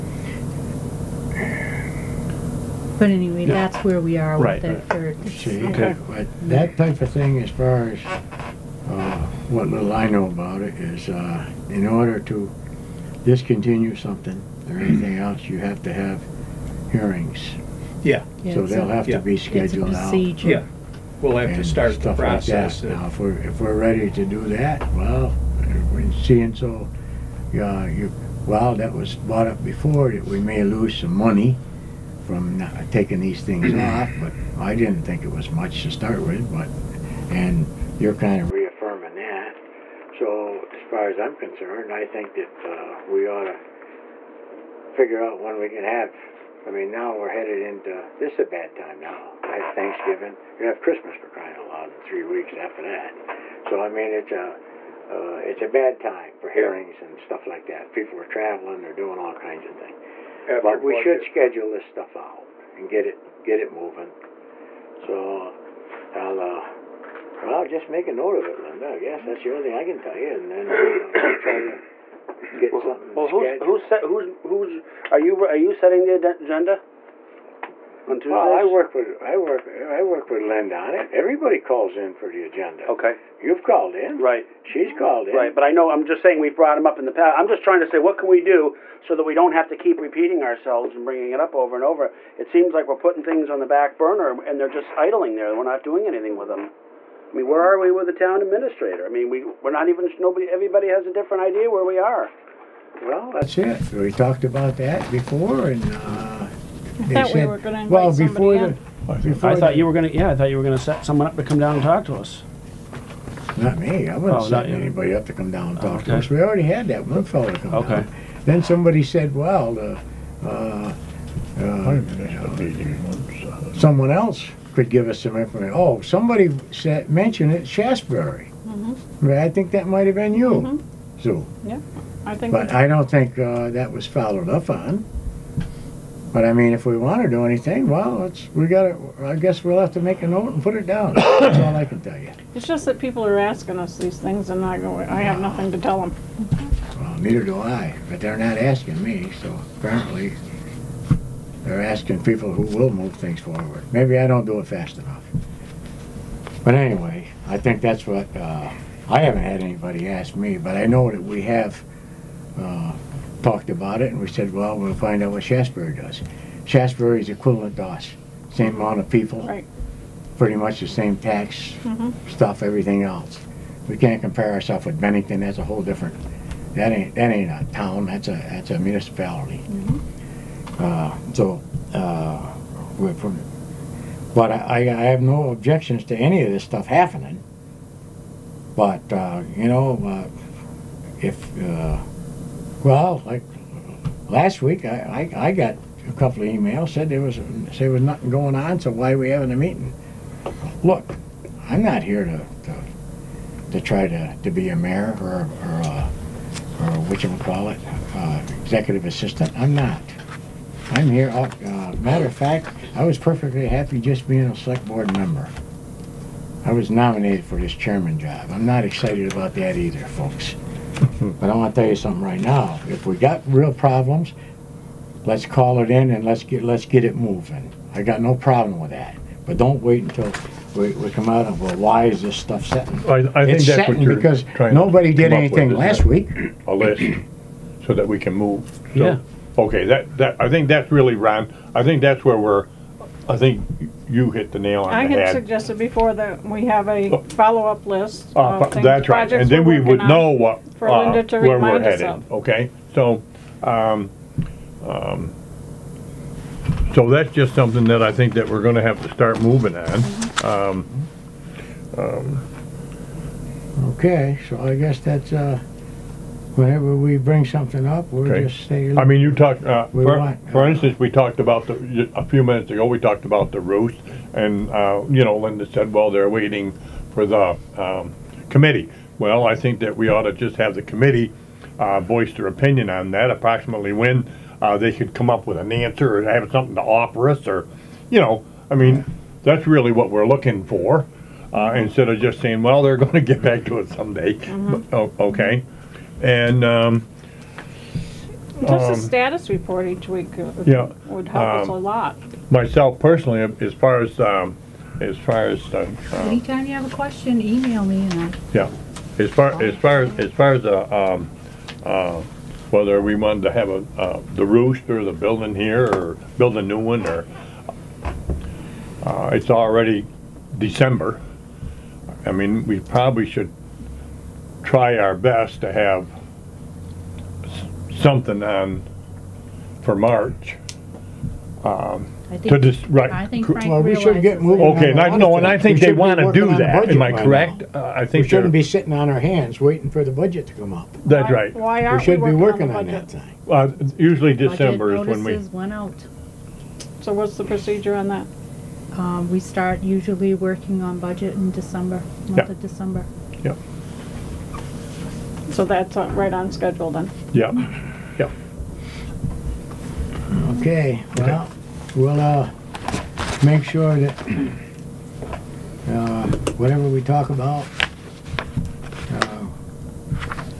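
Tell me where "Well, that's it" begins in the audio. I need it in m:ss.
1:43.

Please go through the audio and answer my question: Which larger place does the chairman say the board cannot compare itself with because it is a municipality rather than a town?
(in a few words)
Bennington.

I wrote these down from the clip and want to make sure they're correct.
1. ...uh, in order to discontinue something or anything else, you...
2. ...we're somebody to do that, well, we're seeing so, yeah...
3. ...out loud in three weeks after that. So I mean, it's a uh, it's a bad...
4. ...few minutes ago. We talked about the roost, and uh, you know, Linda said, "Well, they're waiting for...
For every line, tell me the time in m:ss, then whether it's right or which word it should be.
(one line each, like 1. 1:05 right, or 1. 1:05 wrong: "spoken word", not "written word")
1. 0:11 right
2. 0:23 wrong: "ready", not "somebody"
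3. 0:51 right
4. 4:32 right.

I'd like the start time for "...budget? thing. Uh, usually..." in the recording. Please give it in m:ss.
5:43.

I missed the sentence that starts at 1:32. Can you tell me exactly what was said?
It seems like we're putting things on the back burner and they're just idling there.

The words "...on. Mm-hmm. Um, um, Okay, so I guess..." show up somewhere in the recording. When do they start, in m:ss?
4:19.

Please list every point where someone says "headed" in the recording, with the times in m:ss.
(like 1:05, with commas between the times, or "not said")
0:47, 4:11.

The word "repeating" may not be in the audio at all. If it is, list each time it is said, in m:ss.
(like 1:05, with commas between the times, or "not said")
1:30.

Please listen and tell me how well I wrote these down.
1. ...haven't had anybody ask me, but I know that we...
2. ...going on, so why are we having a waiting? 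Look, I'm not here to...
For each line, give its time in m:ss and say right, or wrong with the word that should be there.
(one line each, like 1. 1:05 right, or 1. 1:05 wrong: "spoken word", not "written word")
1. 2:39 right
2. 3:18 wrong: "meeting", not "waiting".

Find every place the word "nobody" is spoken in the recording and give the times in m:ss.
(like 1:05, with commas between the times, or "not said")
1:40, 3:54.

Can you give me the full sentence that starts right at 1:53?
Not me, I Oh, wasn't setting anybody up to come down and talk to us.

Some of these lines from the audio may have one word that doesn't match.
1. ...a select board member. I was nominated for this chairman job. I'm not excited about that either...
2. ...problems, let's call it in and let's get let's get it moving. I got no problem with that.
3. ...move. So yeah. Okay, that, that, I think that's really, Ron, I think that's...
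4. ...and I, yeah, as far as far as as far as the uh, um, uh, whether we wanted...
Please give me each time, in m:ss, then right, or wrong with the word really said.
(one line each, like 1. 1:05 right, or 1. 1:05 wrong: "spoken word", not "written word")
1. 3:34 right
2. 3:43 right
3. 3:58 right
4. 5:08 right.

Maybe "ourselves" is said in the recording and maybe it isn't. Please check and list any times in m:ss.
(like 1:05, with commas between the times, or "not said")
1:30, 2:54.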